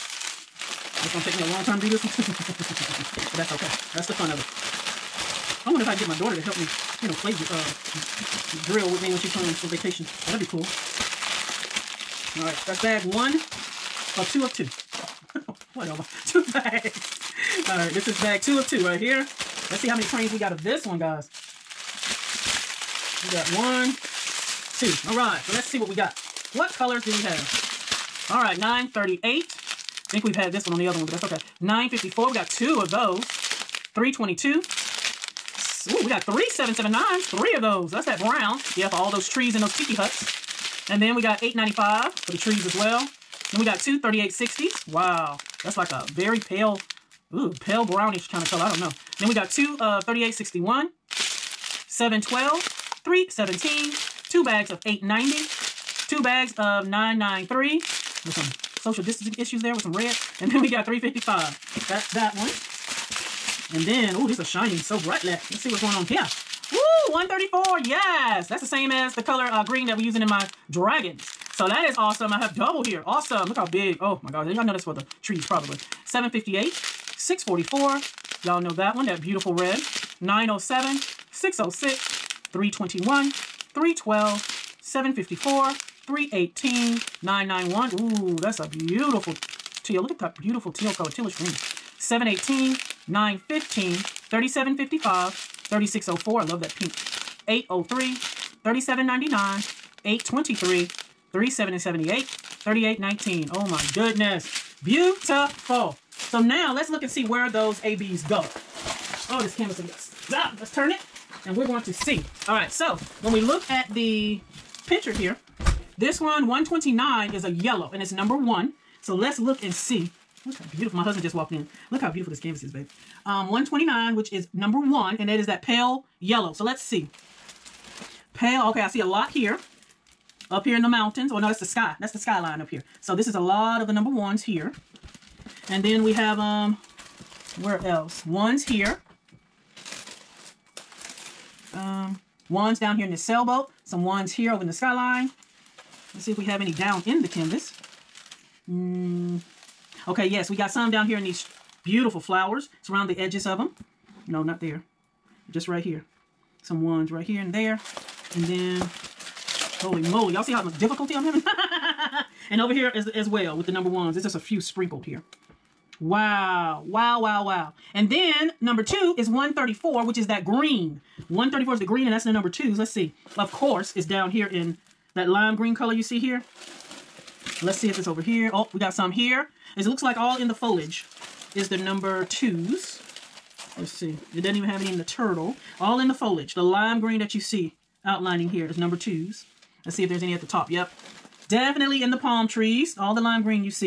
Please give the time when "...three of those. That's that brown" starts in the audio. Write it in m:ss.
0:37.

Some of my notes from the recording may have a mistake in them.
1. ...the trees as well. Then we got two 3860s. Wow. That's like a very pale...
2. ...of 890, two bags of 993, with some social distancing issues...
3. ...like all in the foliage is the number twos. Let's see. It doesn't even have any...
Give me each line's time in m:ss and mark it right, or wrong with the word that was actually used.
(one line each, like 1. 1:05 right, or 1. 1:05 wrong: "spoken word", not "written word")
1. 0:42 right
2. 0:54 right
3. 3:00 right.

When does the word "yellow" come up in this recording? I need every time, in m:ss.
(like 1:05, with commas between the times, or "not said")
1:57, 2:06.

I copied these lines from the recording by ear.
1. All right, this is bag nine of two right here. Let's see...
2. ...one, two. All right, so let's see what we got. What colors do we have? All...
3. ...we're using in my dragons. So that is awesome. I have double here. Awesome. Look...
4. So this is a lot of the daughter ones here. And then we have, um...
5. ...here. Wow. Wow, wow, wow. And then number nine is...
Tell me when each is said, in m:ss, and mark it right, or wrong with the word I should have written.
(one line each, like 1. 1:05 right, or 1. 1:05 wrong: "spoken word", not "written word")
1. 0:17 wrong: "two", not "nine"
2. 0:23 right
3. 1:09 right
4. 2:13 wrong: "number", not "daughter"
5. 2:45 wrong: "two", not "nine".